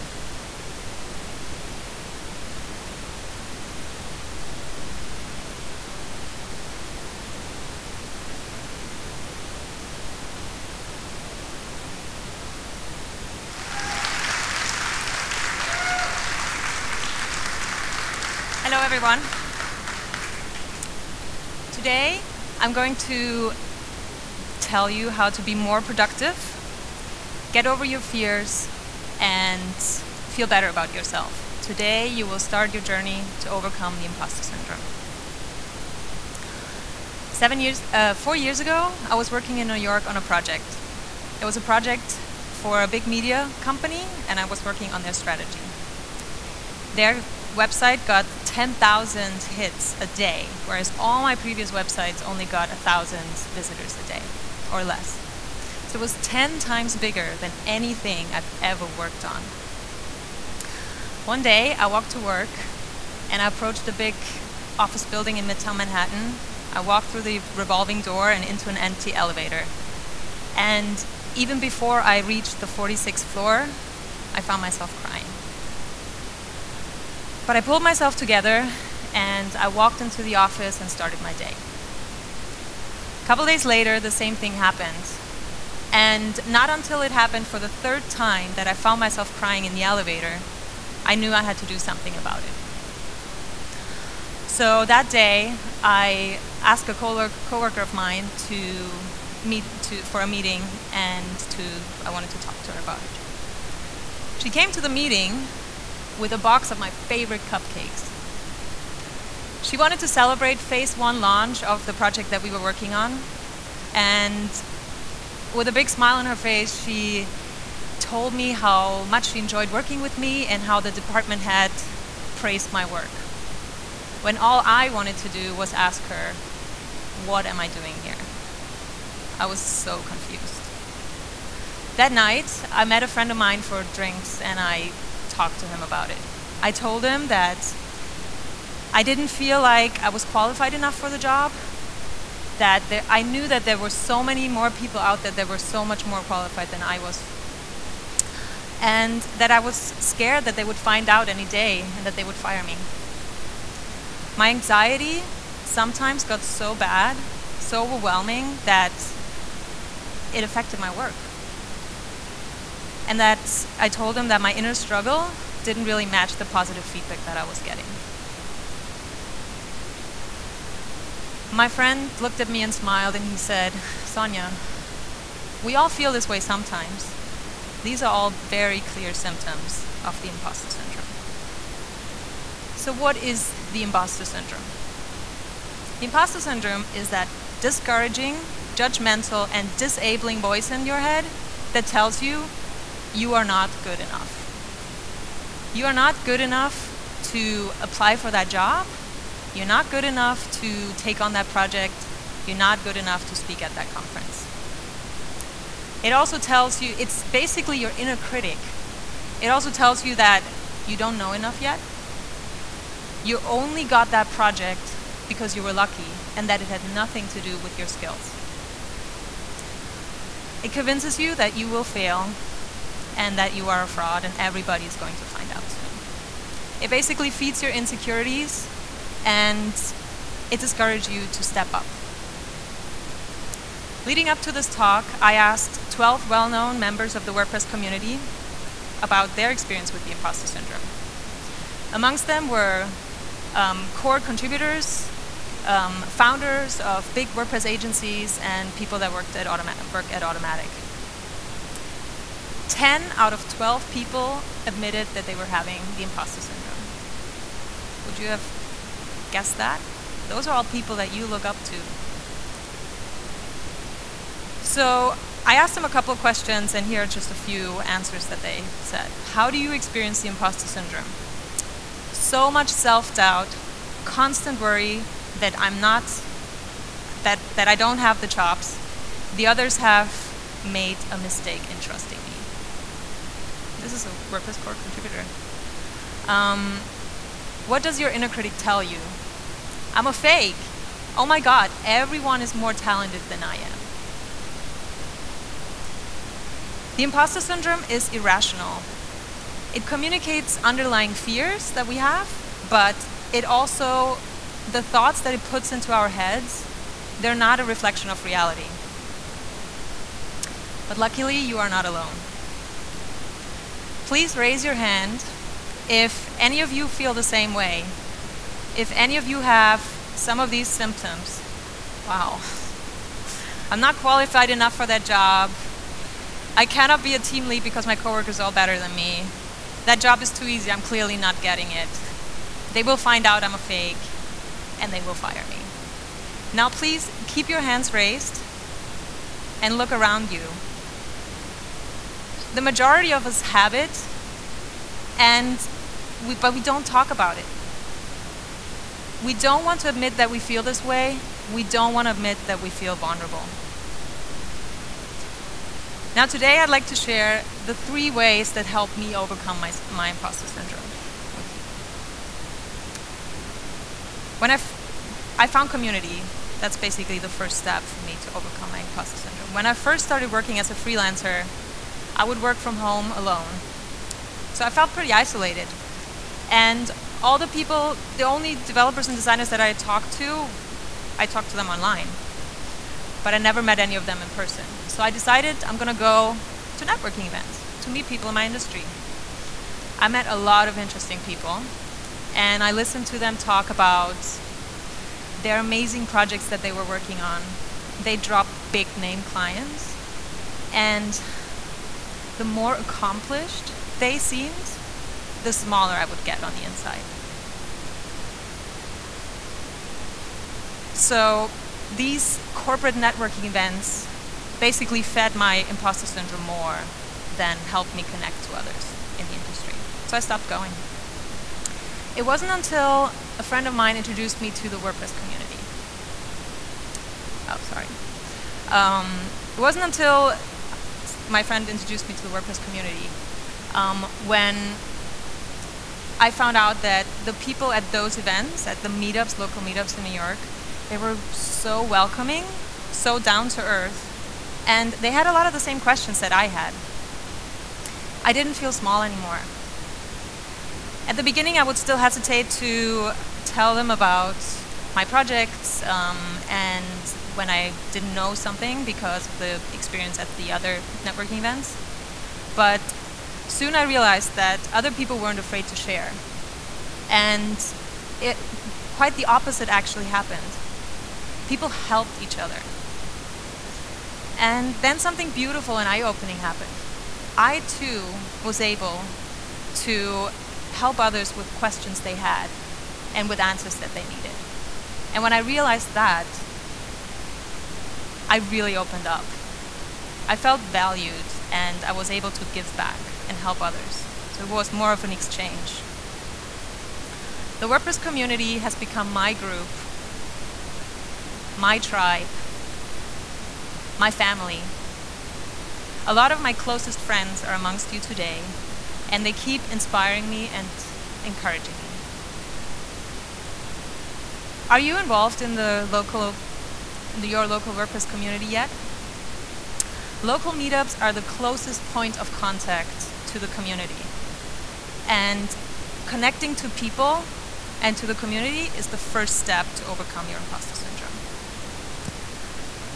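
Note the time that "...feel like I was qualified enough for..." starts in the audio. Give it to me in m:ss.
2:19.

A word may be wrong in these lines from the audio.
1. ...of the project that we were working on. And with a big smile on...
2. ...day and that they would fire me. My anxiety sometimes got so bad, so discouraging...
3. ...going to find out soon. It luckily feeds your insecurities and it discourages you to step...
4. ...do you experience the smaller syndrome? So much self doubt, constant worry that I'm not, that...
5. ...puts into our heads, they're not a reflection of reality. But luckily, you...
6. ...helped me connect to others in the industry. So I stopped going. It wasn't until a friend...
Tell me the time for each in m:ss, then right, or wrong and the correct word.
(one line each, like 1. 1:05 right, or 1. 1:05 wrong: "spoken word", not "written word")
1. 1:51 right
2. 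2:31 wrong: "overwhelming", not "discouraging"
3. 3:44 wrong: "basically", not "luckily"
4. 4:29 wrong: "imposter", not "smaller"
5. 5:05 right
6. 6:57 right.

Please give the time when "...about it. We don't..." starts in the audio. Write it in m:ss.
5:47.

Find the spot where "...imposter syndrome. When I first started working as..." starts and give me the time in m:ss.
6:08.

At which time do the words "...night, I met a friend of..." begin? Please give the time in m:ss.
2:12.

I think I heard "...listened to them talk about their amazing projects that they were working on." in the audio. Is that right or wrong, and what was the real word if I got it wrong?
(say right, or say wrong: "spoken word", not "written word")
right.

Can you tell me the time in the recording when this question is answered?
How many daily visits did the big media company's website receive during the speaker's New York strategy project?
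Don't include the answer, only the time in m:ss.
0:48.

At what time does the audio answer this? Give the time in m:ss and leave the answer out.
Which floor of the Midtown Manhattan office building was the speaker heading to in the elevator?
1:12.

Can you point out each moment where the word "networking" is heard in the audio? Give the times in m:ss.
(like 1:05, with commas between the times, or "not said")
6:26, 6:52, 7:41.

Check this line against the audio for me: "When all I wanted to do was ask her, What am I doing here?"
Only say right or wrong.
right.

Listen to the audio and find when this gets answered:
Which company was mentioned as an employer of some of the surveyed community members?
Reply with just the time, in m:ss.
4:10.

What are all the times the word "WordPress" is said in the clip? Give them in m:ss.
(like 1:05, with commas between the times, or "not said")
3:57, 4:07, 4:44, 7:04, 7:12, 8:17, 8:37.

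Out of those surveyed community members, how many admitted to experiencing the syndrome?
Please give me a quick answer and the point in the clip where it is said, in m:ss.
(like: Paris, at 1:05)
10, at 4:12.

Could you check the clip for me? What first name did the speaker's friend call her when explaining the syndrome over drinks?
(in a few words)
Sonja.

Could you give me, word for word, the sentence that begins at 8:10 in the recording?
I felt valued and I was able to give back and help others.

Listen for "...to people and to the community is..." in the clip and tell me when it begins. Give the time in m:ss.
8:46.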